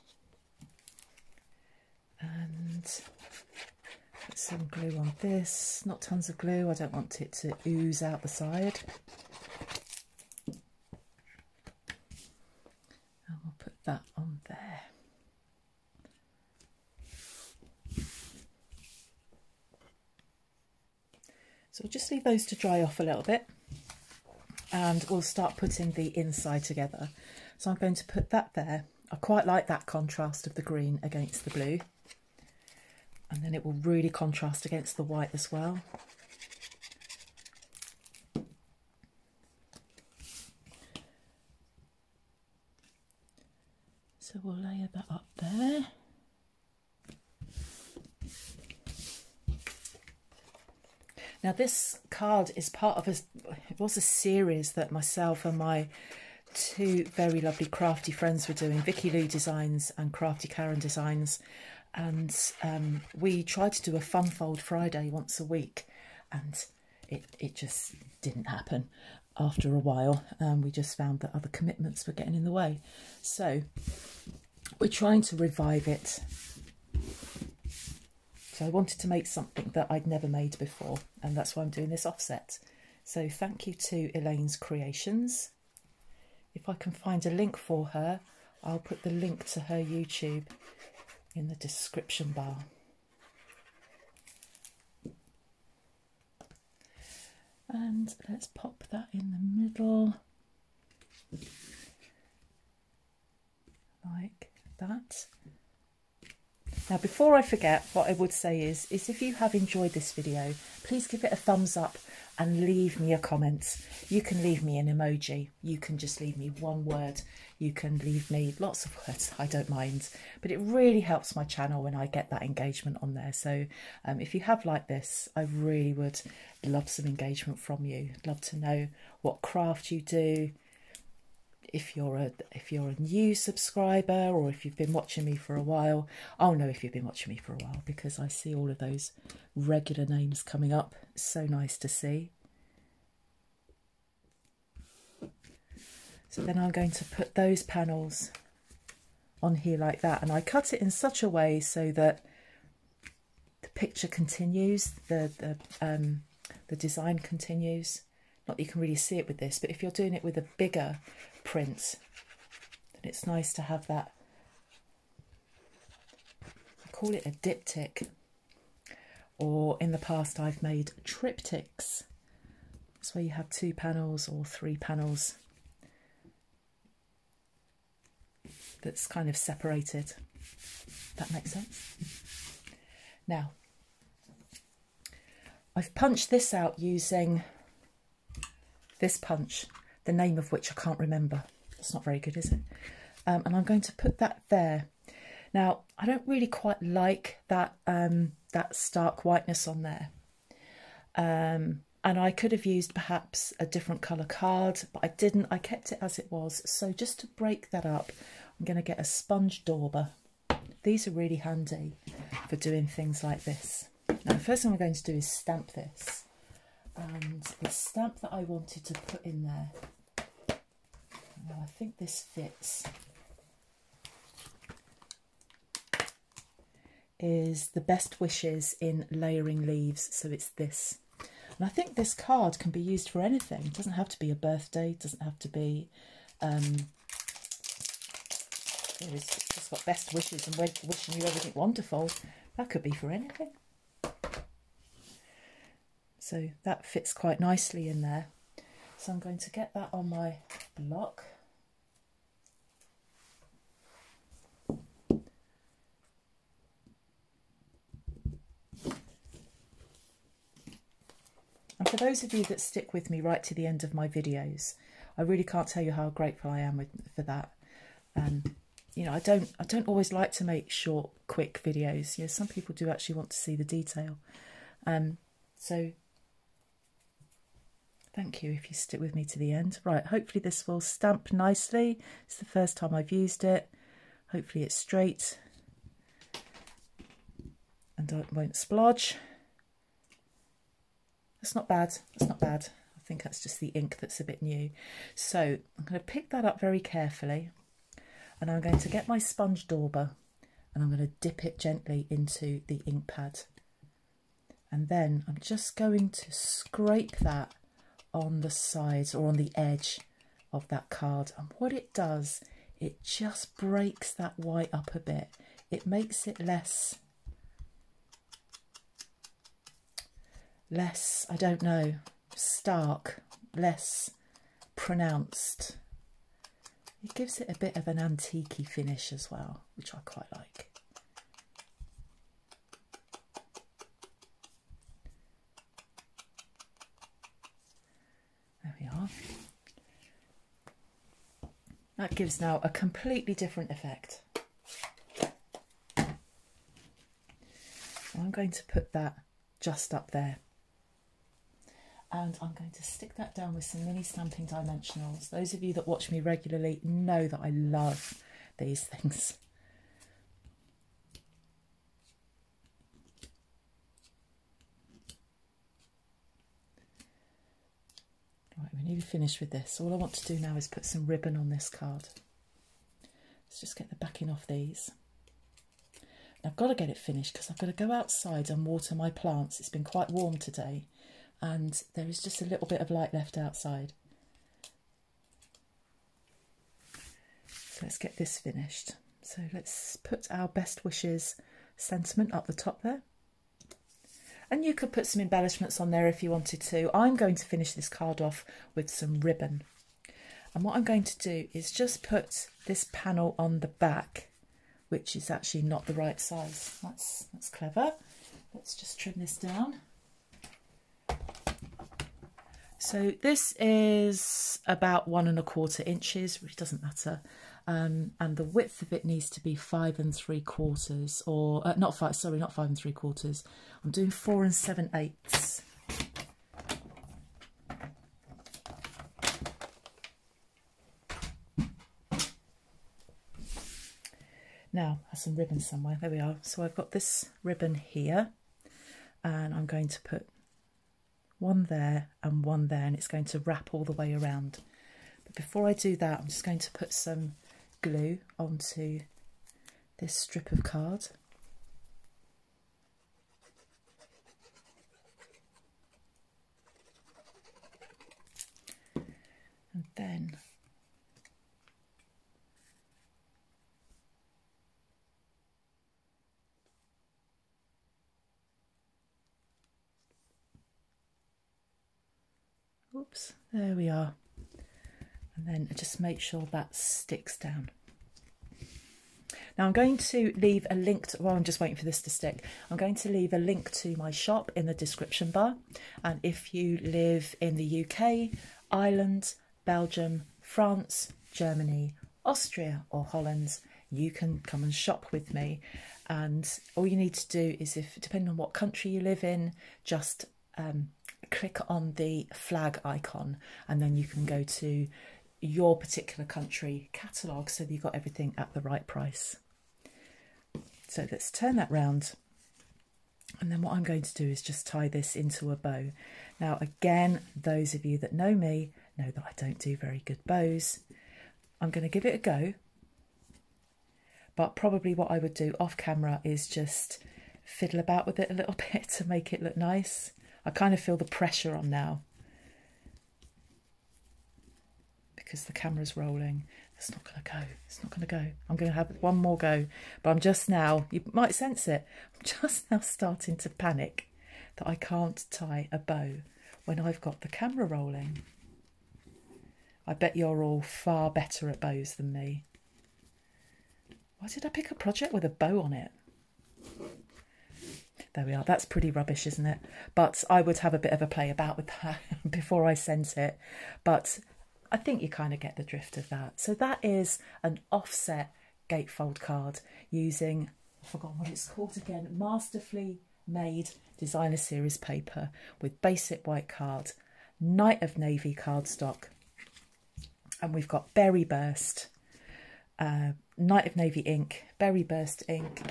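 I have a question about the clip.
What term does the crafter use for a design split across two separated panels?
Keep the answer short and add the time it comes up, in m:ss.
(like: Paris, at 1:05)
diptych, at 2:47.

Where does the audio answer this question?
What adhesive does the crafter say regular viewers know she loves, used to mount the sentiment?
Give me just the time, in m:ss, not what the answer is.
5:53.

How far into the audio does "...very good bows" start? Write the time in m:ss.
8:39.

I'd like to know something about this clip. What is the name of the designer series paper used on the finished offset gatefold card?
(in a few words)
Masterfully Made.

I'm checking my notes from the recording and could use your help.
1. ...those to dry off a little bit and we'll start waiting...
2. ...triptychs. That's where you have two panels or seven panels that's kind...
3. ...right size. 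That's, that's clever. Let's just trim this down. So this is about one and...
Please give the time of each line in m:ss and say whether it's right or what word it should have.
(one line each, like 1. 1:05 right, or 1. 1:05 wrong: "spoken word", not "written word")
1. 0:22 wrong: "putting", not "waiting"
2. 2:51 wrong: "three", not "seven"
3. 6:45 right.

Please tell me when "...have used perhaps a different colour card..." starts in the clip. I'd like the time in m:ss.
3:22.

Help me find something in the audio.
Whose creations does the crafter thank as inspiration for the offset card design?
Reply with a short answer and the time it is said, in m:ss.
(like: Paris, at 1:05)
Elaine's Creations, at 1:24.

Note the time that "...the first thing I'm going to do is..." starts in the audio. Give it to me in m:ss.
3:34.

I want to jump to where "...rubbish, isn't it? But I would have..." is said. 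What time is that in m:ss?
9:18.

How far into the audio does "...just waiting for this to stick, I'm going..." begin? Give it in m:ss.
8:01.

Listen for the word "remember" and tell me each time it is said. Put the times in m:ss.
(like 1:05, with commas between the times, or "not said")
3:10.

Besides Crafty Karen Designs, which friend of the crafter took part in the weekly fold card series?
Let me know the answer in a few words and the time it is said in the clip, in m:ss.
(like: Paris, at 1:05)
Vicky Lou Designs, at 0:58.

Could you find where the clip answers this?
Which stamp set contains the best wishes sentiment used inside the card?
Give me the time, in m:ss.
3:49.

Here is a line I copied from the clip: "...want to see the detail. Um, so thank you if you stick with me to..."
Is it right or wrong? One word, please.
right.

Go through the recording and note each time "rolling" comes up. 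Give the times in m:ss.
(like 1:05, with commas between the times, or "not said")
8:55, 9:07.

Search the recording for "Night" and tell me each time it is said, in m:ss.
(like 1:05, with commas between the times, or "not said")
9:37, 9:43.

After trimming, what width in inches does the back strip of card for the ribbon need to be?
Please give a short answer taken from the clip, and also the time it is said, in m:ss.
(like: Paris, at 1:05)
4 7/8 inches, at 7:04.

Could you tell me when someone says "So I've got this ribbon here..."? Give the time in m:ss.
7:16.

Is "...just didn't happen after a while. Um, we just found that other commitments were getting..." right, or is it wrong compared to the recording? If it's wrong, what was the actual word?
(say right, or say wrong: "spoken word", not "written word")
right.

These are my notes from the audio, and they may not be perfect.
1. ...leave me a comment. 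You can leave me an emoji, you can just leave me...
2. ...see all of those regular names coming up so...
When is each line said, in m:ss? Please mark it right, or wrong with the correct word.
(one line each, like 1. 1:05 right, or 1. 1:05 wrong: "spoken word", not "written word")
1. 1:52 right
2. 2:18 right.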